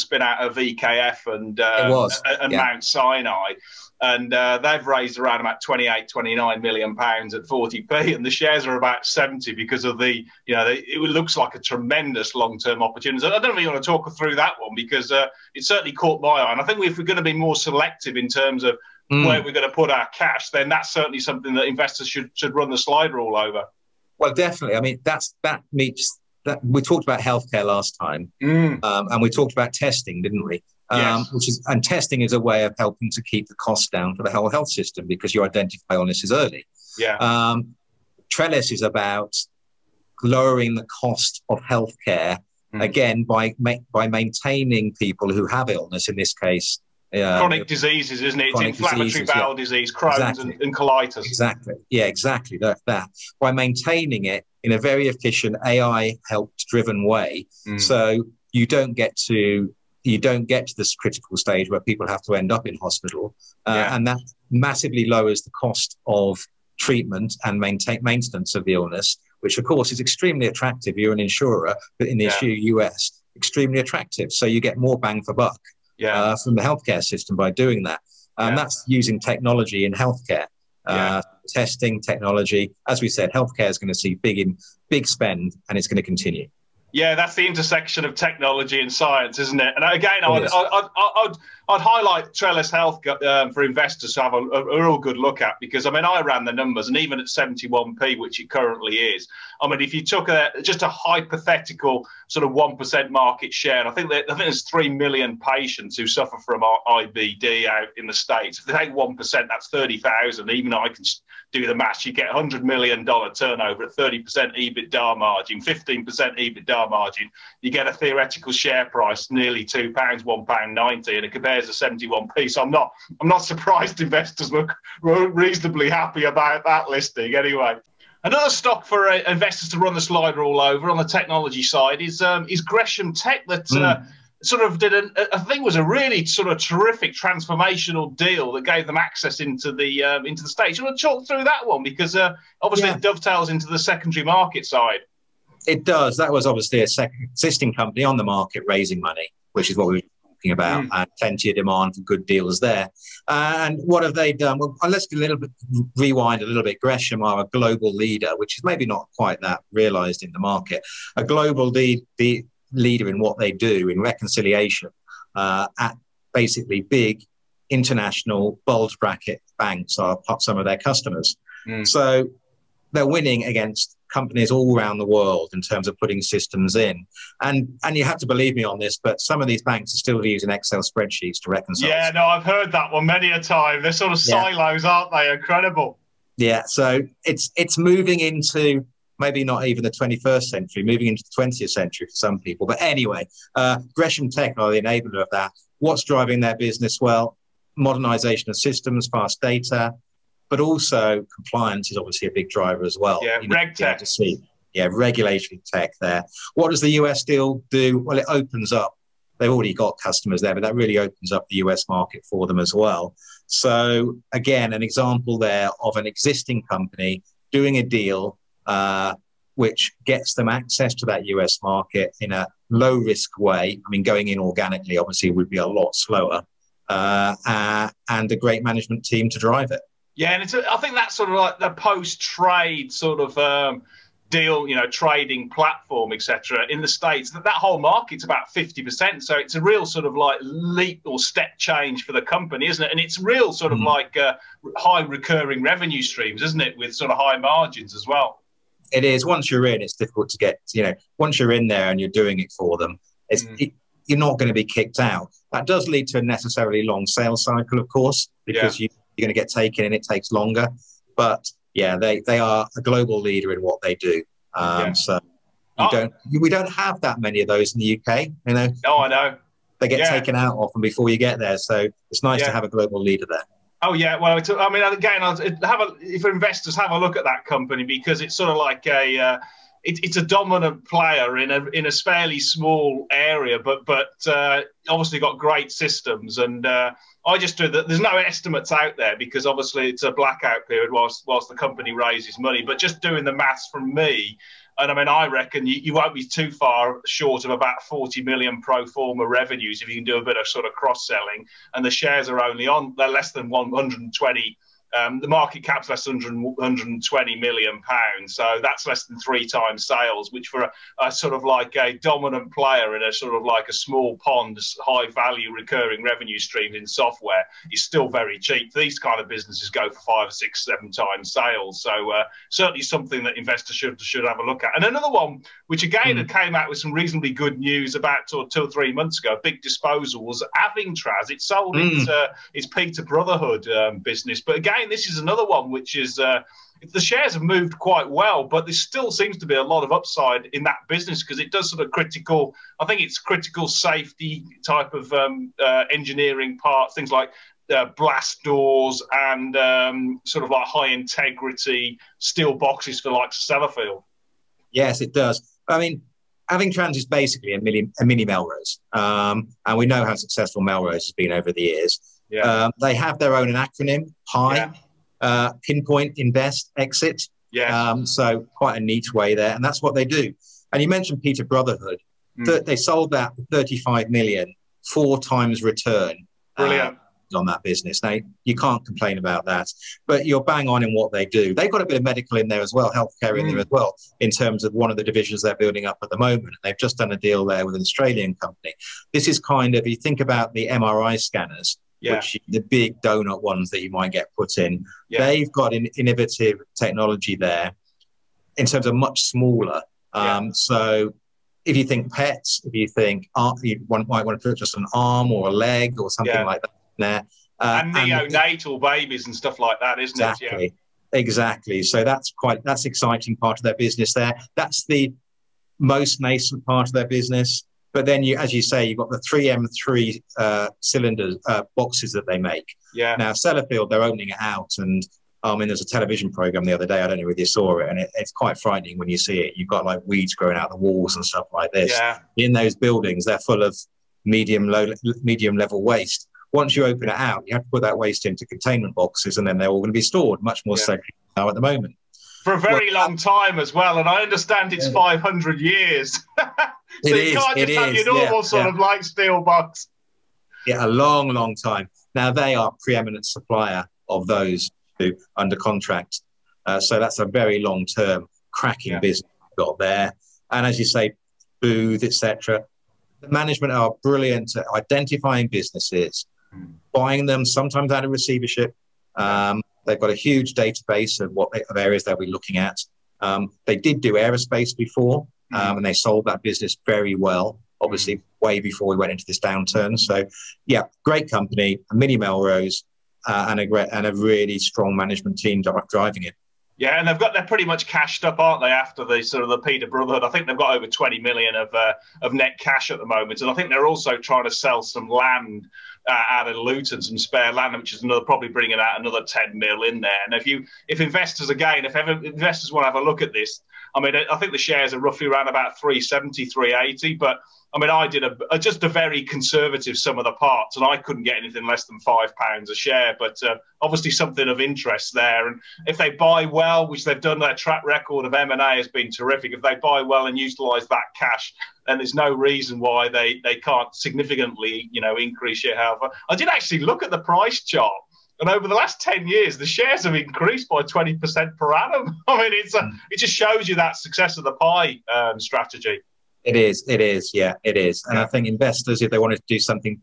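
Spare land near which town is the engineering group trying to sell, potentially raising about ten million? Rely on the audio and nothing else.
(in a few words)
Luton.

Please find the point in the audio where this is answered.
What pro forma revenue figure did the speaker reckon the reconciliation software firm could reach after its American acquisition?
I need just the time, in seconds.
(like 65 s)
297 s.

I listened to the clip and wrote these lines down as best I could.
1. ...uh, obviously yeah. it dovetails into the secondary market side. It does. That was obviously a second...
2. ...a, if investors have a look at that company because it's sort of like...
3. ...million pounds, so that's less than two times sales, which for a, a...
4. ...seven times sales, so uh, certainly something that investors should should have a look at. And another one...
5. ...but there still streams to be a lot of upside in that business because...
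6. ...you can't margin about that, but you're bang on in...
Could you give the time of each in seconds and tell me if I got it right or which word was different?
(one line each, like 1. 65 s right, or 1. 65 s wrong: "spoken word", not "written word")
1. 142 s right
2. 275 s right
3. 307 s wrong: "three", not "two"
4. 320 s right
5. 338 s wrong: "seems", not "streams"
6. 378 s wrong: "complain", not "margin".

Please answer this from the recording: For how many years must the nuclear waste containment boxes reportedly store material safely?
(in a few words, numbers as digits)
500 years.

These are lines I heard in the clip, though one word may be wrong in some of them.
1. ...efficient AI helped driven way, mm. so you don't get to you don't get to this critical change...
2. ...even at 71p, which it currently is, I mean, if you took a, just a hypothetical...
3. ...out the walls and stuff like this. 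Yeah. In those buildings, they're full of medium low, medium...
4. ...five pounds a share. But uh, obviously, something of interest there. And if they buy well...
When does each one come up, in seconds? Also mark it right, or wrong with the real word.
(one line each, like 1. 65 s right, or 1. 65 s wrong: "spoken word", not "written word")
1. 55 s wrong: "stage", not "change"
2. 96 s right
3. 430 s right
4. 512 s right.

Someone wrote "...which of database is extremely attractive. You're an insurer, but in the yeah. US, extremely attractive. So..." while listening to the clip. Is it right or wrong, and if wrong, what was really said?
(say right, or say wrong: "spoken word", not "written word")
wrong: "course", not "database".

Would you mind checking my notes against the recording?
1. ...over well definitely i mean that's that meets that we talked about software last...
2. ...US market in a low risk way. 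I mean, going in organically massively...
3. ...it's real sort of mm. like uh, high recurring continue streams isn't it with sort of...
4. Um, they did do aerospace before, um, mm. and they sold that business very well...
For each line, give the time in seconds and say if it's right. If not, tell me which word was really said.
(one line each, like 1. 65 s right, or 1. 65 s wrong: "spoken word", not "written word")
1. 23 s wrong: "healthcare", not "software"
2. 221 s wrong: "obviously", not "massively"
3. 242 s wrong: "revenue", not "continue"
4. 473 s right.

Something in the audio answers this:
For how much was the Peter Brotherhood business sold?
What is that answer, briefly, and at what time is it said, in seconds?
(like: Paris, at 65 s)
35 million, at 373 s.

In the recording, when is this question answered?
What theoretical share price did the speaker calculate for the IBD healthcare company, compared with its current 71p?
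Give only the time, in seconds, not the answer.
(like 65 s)
119 s.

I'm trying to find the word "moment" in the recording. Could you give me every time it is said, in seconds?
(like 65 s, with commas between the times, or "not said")
386 s, 441 s, 493 s.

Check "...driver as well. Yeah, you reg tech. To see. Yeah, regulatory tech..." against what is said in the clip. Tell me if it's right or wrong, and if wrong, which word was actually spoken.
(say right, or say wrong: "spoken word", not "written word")
right.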